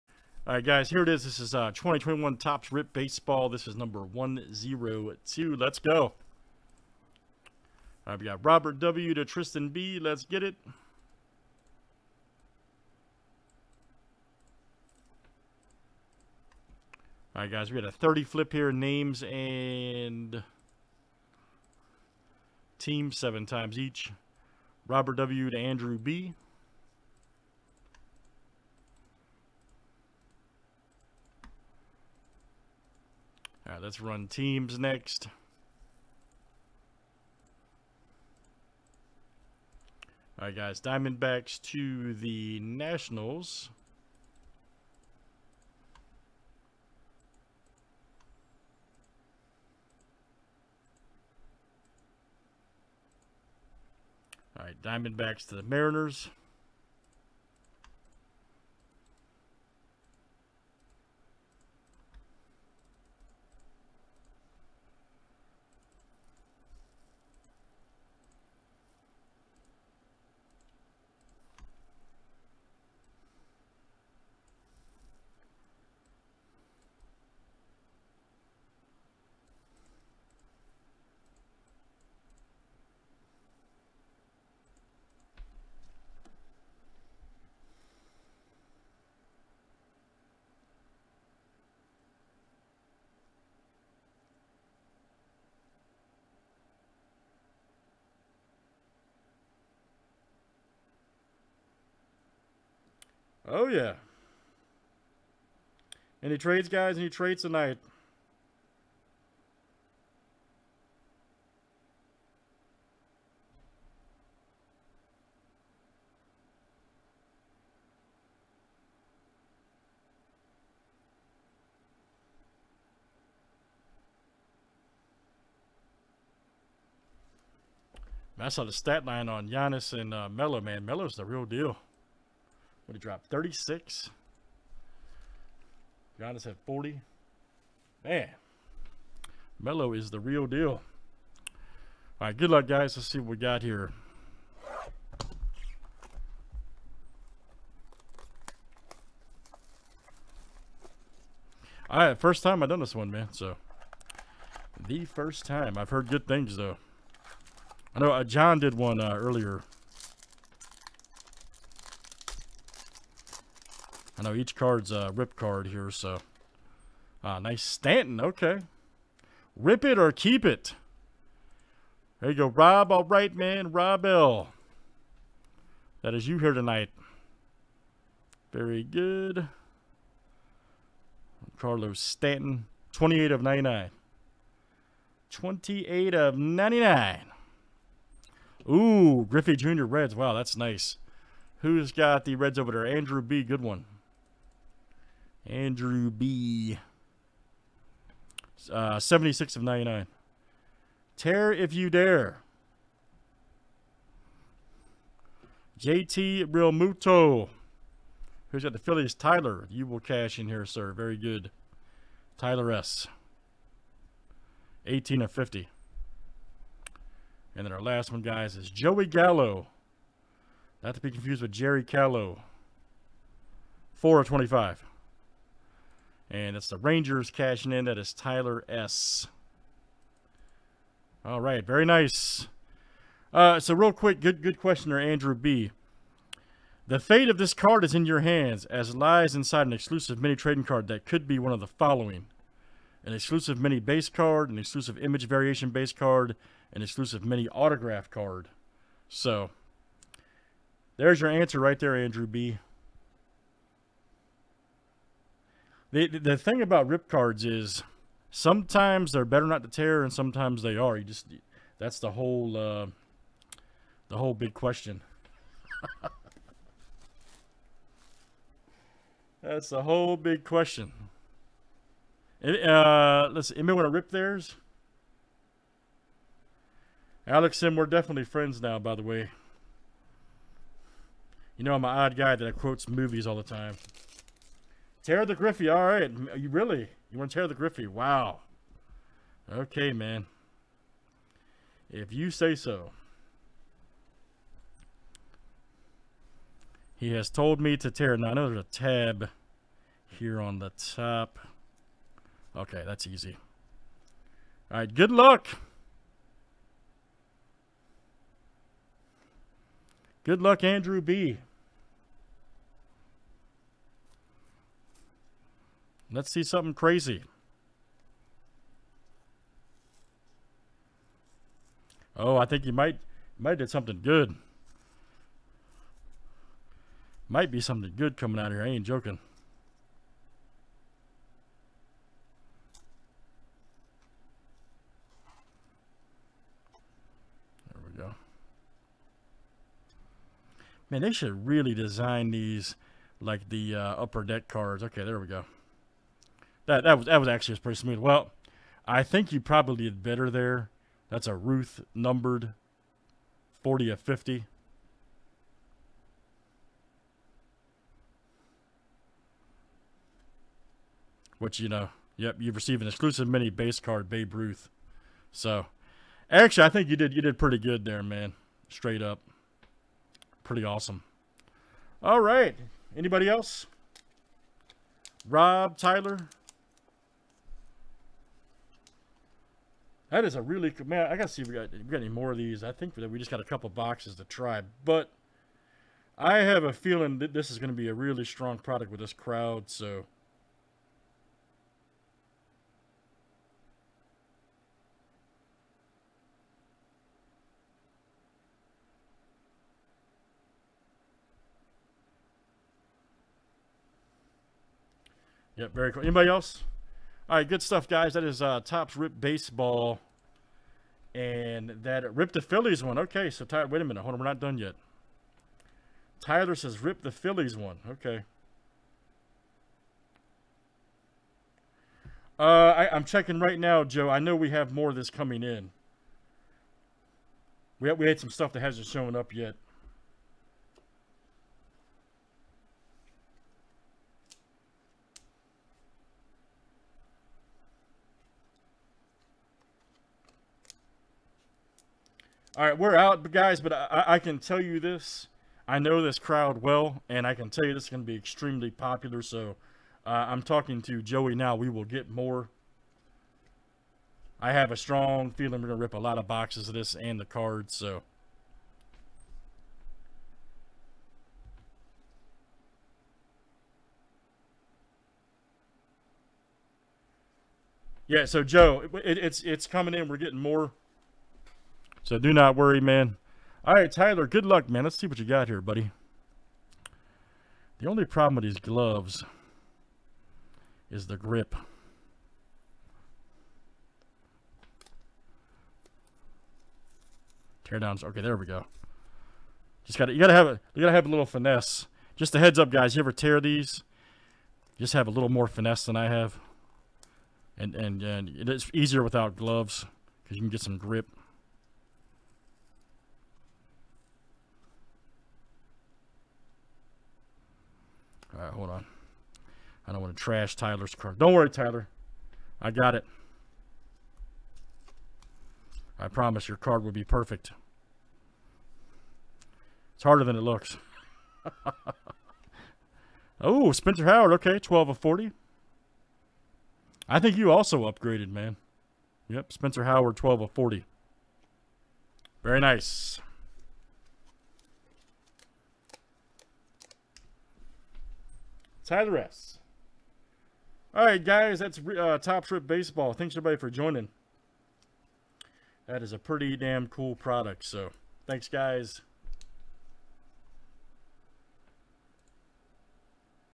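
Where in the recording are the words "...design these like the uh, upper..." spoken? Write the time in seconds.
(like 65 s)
341 s.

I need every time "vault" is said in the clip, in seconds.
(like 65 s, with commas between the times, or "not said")
not said.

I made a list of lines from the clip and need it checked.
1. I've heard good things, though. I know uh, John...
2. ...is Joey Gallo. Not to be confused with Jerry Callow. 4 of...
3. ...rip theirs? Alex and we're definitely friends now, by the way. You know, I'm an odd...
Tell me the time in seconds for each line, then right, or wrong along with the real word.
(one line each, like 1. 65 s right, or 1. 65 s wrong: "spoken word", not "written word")
1. 155 s right
2. 218 s right
3. 273 s right.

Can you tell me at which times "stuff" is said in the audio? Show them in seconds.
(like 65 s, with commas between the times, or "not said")
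407 s, 428 s.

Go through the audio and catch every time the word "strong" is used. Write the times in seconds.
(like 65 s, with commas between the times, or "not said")
388 s, 454 s.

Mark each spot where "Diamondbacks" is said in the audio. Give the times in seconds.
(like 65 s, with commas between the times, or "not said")
40 s, 54 s.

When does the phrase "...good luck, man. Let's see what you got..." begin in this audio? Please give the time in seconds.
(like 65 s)
474 s.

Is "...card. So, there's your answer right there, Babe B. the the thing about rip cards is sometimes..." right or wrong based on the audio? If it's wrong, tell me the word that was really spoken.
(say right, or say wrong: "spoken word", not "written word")
wrong: "Andrew", not "Babe".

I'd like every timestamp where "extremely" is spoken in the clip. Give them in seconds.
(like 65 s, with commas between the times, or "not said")
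448 s.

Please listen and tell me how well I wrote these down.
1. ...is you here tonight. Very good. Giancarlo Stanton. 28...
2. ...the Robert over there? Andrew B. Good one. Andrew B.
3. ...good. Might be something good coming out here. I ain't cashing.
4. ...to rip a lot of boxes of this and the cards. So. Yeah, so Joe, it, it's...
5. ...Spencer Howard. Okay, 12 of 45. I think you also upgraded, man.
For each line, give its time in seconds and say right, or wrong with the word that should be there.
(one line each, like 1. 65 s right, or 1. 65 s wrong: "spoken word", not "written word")
1. 176 s right
2. 192 s wrong: "Reds", not "Robert"
3. 324 s wrong: "joking", not "cashing"
4. 455 s right
5. 523 s wrong: "40", not "45".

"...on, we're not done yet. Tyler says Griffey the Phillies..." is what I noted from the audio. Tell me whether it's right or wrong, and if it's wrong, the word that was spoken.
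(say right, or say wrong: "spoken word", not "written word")
wrong: "Rip", not "Griffey".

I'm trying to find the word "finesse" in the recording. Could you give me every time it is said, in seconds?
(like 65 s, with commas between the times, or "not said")
491 s, 495 s.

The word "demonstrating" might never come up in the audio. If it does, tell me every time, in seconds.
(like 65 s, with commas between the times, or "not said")
not said.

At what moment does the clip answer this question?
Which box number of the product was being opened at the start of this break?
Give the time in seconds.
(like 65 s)
3 s.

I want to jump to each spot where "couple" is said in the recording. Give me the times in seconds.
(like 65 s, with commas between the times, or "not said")
383 s.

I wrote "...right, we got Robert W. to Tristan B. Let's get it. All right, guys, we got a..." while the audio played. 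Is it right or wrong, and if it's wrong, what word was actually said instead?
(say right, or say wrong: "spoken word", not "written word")
right.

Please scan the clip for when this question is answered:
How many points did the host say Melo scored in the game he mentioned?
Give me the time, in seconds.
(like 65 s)
132 s.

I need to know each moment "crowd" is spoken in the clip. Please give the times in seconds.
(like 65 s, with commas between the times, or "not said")
389 s, 446 s.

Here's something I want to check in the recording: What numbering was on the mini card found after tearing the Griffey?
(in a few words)
40 of 50.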